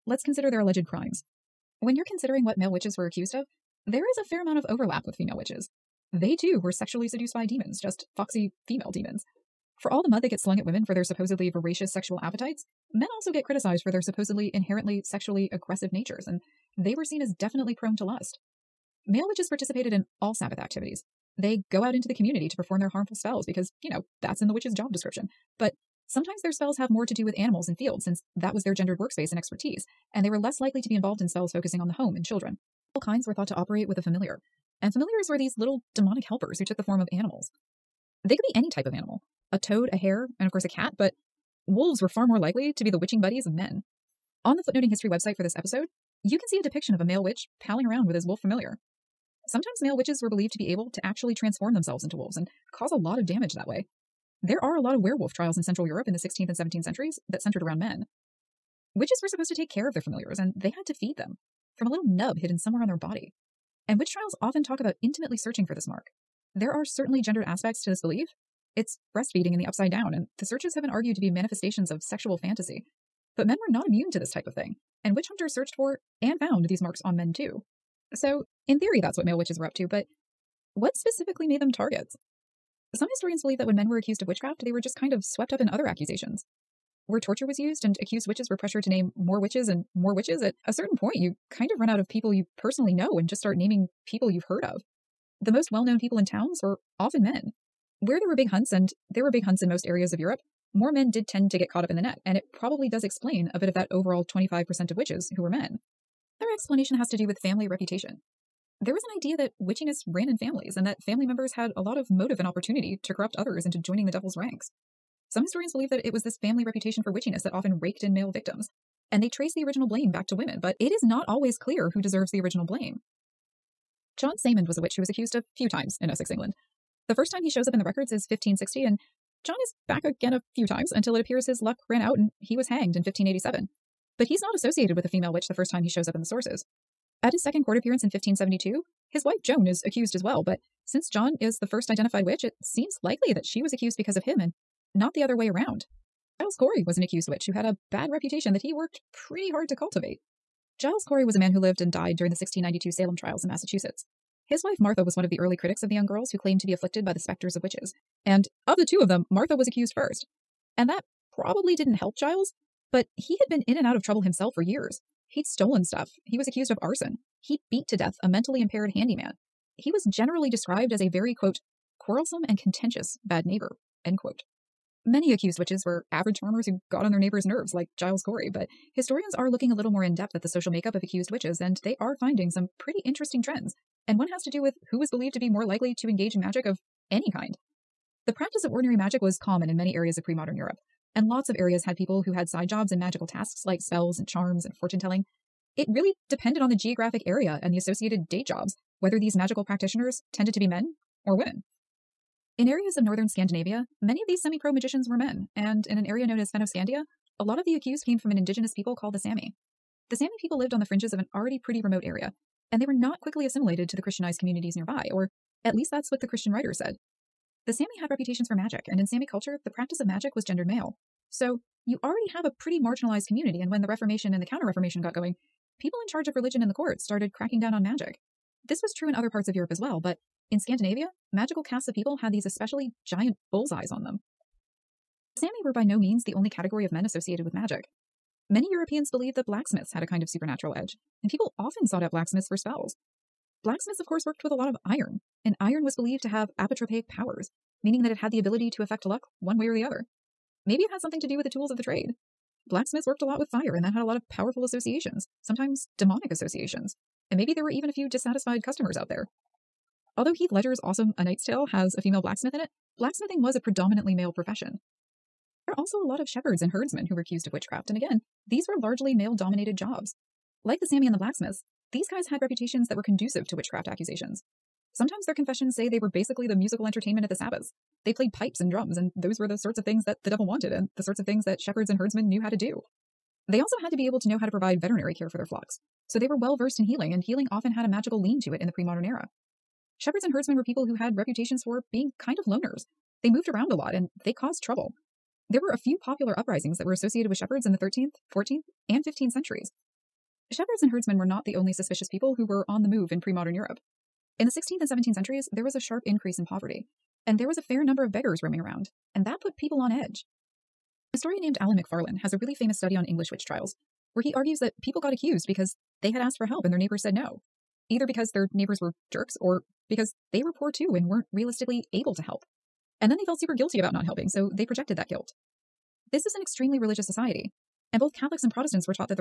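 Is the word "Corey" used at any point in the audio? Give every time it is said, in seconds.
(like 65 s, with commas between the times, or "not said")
146 s, 151 s, 178 s.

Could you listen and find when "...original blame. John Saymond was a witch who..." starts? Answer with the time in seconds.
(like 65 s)
122 s.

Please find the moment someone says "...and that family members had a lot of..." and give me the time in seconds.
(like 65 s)
110 s.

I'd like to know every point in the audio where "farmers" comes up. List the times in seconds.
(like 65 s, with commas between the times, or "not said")
176 s.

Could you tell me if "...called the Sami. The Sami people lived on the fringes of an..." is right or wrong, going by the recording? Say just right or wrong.
right.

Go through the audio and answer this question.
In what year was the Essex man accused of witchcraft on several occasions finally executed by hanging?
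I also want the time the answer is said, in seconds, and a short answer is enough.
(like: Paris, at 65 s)
1587, at 132 s.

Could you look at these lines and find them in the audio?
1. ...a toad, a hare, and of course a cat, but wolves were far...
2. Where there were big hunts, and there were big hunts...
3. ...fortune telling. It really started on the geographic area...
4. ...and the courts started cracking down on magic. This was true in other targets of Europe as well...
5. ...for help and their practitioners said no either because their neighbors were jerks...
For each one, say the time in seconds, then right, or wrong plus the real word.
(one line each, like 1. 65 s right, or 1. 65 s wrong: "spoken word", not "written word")
1. 39 s right
2. 98 s right
3. 194 s wrong: "depended", not "started"
4. 226 s wrong: "parts", not "targets"
5. 316 s wrong: "neighbors", not "practitioners".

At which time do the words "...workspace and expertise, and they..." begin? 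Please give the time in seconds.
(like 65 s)
28 s.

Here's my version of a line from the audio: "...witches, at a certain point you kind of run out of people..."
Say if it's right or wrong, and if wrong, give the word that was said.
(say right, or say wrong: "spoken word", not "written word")
right.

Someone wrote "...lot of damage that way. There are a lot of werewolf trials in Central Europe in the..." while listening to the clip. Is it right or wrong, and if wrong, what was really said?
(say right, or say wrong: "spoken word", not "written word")
right.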